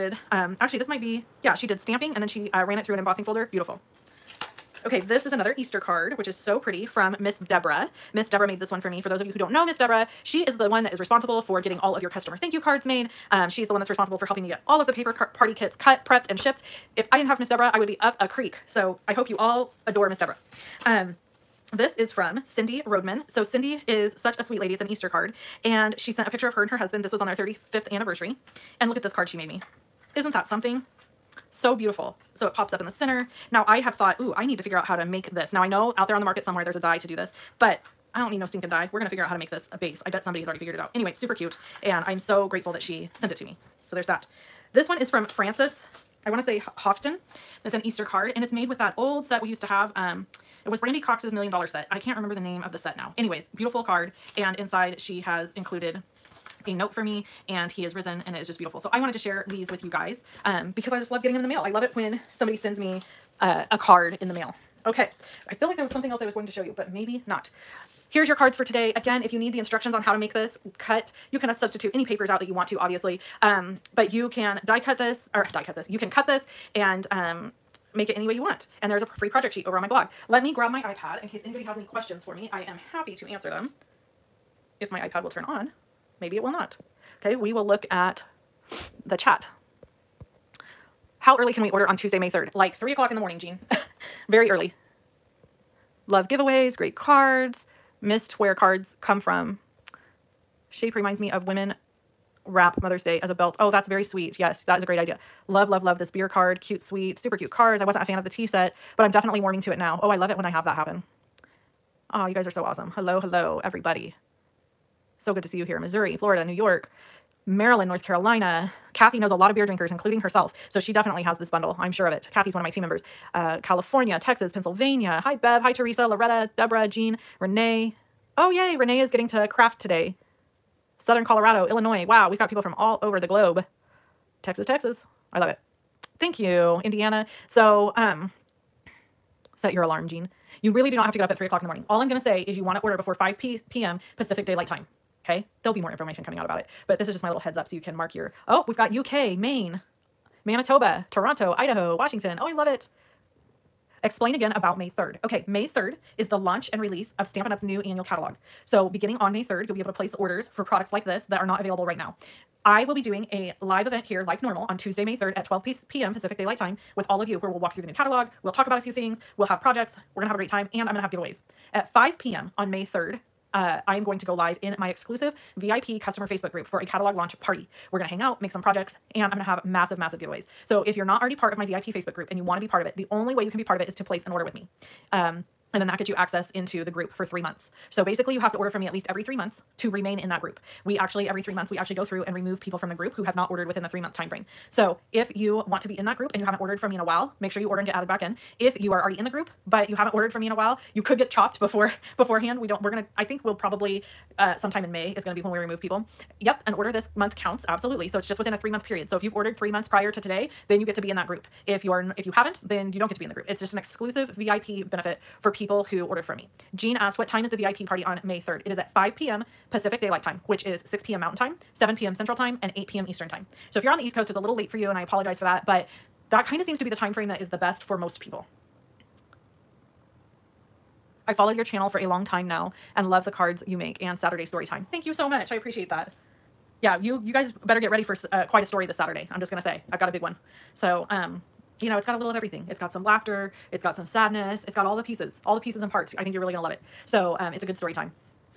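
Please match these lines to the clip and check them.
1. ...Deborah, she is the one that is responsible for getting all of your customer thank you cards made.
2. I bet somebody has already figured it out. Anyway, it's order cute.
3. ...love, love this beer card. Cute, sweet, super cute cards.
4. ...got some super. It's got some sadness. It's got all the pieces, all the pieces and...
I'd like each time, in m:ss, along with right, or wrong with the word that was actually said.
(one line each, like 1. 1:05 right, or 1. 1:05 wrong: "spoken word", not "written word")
1. 0:09 right
2. 0:40 wrong: "super", not "order"
3. 1:45 right
4. 4:02 wrong: "laughter", not "super".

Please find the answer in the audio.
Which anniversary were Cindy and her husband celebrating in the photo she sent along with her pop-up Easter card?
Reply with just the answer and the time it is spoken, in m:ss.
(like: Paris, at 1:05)
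35th, at 0:27.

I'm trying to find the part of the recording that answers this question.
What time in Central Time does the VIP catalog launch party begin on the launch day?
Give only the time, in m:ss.
3:41.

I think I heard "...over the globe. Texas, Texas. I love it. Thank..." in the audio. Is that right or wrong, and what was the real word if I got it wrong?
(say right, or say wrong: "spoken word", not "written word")
right.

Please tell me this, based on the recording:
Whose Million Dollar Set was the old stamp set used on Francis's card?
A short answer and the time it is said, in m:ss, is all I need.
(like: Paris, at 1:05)
Brandy Cox, at 0:50.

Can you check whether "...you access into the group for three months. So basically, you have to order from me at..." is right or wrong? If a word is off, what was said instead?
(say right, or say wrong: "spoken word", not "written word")
right.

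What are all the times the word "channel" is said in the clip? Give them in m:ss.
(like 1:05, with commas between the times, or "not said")
3:51.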